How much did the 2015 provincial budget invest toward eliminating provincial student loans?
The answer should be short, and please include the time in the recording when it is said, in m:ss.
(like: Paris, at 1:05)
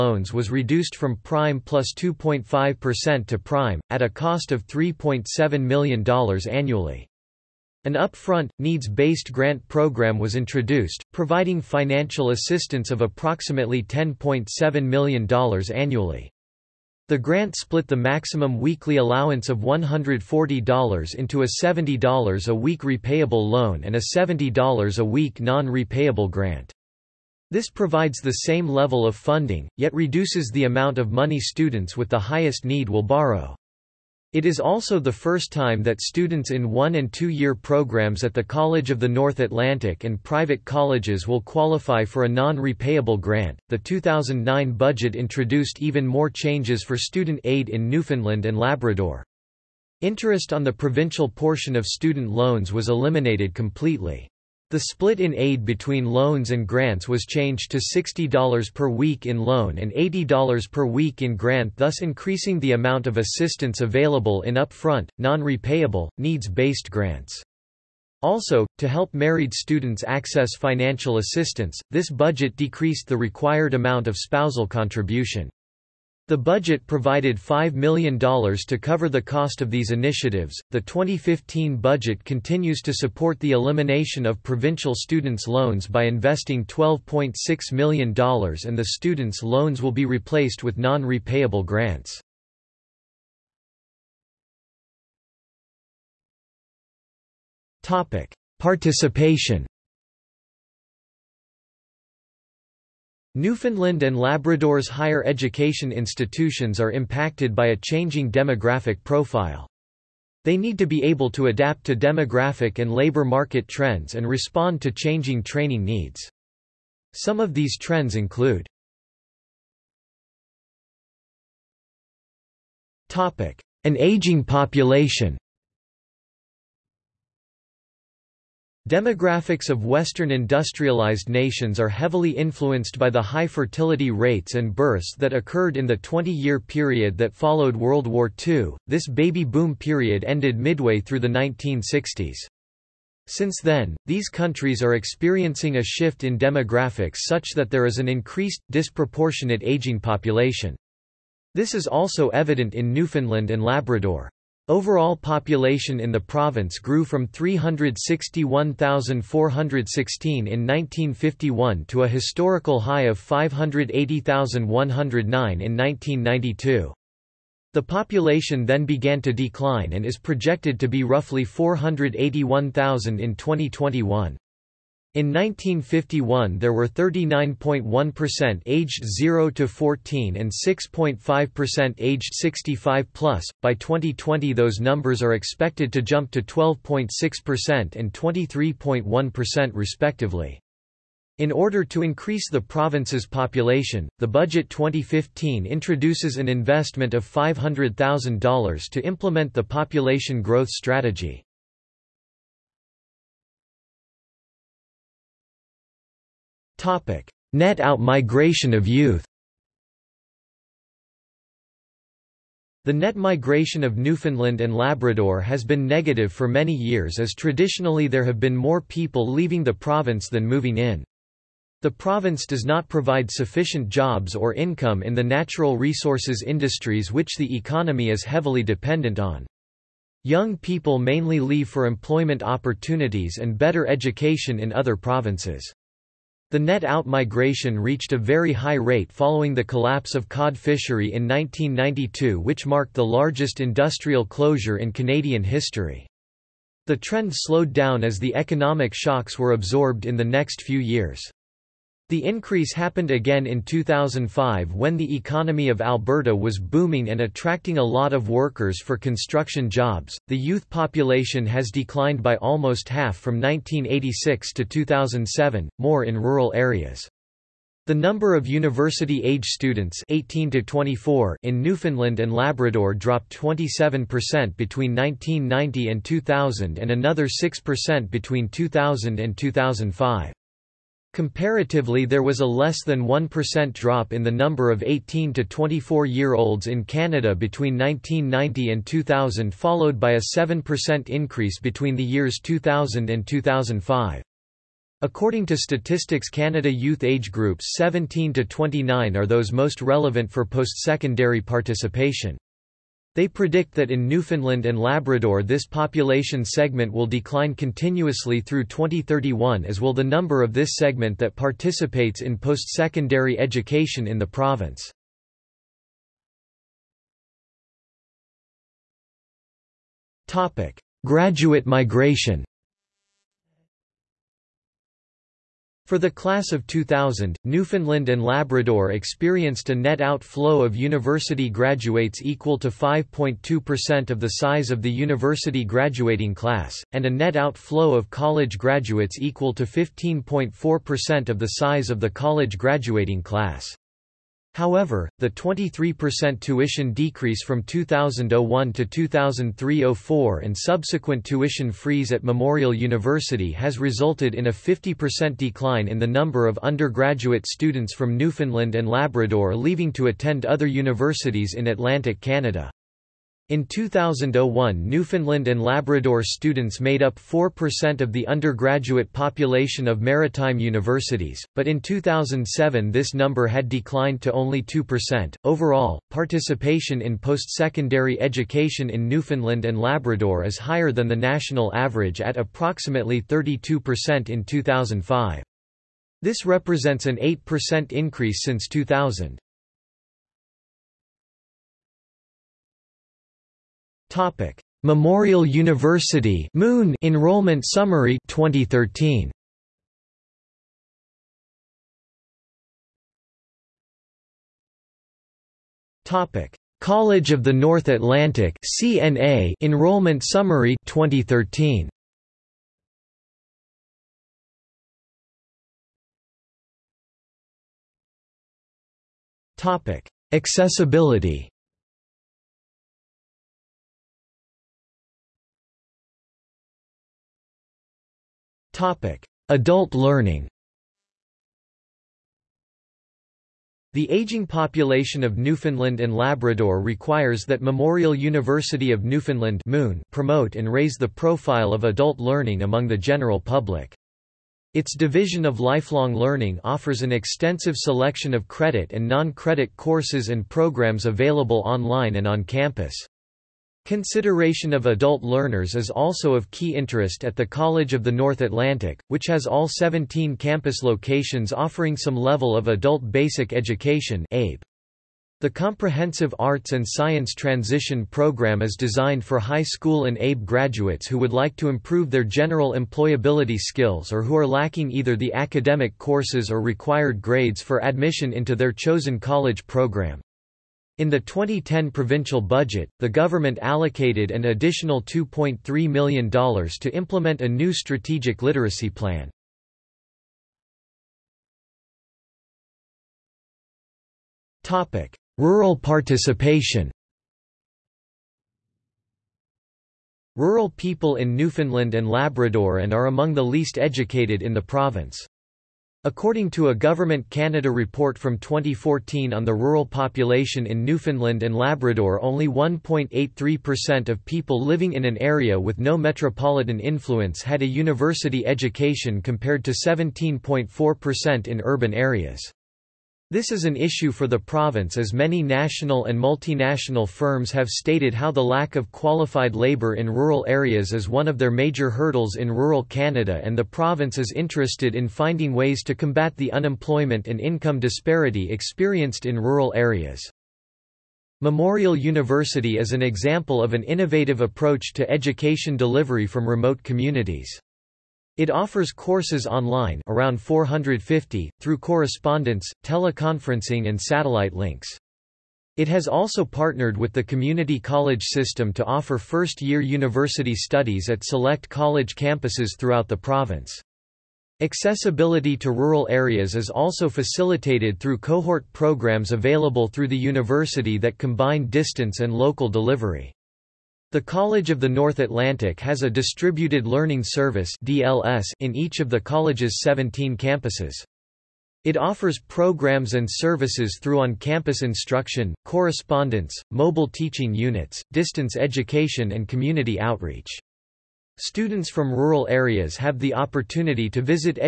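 $12.6 million, at 1:26.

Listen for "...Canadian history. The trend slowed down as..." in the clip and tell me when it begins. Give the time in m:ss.
4:04.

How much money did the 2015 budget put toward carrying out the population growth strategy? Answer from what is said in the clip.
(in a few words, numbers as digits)
$500,000.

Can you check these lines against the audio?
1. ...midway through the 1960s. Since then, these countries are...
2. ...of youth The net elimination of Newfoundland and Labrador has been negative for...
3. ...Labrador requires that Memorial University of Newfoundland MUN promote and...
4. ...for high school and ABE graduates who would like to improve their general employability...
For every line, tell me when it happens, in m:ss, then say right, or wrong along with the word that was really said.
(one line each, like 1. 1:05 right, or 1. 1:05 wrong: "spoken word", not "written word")
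1. 2:20 right
2. 3:28 wrong: "migration", not "elimination"
3. 7:16 right
4. 7:49 right.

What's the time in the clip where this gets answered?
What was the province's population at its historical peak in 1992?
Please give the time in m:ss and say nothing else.
2:43.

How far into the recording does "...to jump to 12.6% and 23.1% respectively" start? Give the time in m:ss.
3:05.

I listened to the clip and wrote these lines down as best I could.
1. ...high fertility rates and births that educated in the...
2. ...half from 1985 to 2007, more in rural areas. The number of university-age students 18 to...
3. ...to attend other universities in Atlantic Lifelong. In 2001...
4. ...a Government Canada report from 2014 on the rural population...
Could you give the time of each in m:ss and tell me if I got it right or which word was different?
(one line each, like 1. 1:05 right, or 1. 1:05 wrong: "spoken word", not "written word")
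1. 2:13 wrong: "occurred", not "educated"
2. 4:22 wrong: "1986", not "1985"
3. 5:59 wrong: "Canada", not "Lifelong"
4. 8:26 right.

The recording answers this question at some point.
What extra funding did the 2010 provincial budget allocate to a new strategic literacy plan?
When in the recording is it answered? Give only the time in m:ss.
8:05.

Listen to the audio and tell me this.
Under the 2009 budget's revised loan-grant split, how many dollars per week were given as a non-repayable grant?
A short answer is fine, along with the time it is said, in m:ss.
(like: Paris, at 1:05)
$80, at 0:59.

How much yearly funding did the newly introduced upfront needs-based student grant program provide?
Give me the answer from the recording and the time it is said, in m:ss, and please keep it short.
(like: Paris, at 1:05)
$10.7 million, at 0:13.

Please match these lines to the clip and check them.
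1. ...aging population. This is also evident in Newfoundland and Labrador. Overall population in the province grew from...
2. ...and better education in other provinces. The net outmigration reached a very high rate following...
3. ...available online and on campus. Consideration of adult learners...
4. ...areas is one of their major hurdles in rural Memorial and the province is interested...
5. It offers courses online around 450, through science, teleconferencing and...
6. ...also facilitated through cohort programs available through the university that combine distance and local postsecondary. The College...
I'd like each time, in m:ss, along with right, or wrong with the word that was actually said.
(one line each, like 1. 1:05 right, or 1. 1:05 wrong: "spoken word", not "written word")
1. 2:29 right
2. 3:53 right
3. 7:31 right
4. 8:50 wrong: "Canada", not "Memorial"
5. 9:08 wrong: "correspondence", not "science"
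6. 9:26 wrong: "delivery", not "postsecondary".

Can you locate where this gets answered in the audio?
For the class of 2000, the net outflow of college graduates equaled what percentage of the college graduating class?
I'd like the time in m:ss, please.
5:39.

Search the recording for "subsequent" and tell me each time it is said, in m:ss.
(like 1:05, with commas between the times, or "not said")
5:50.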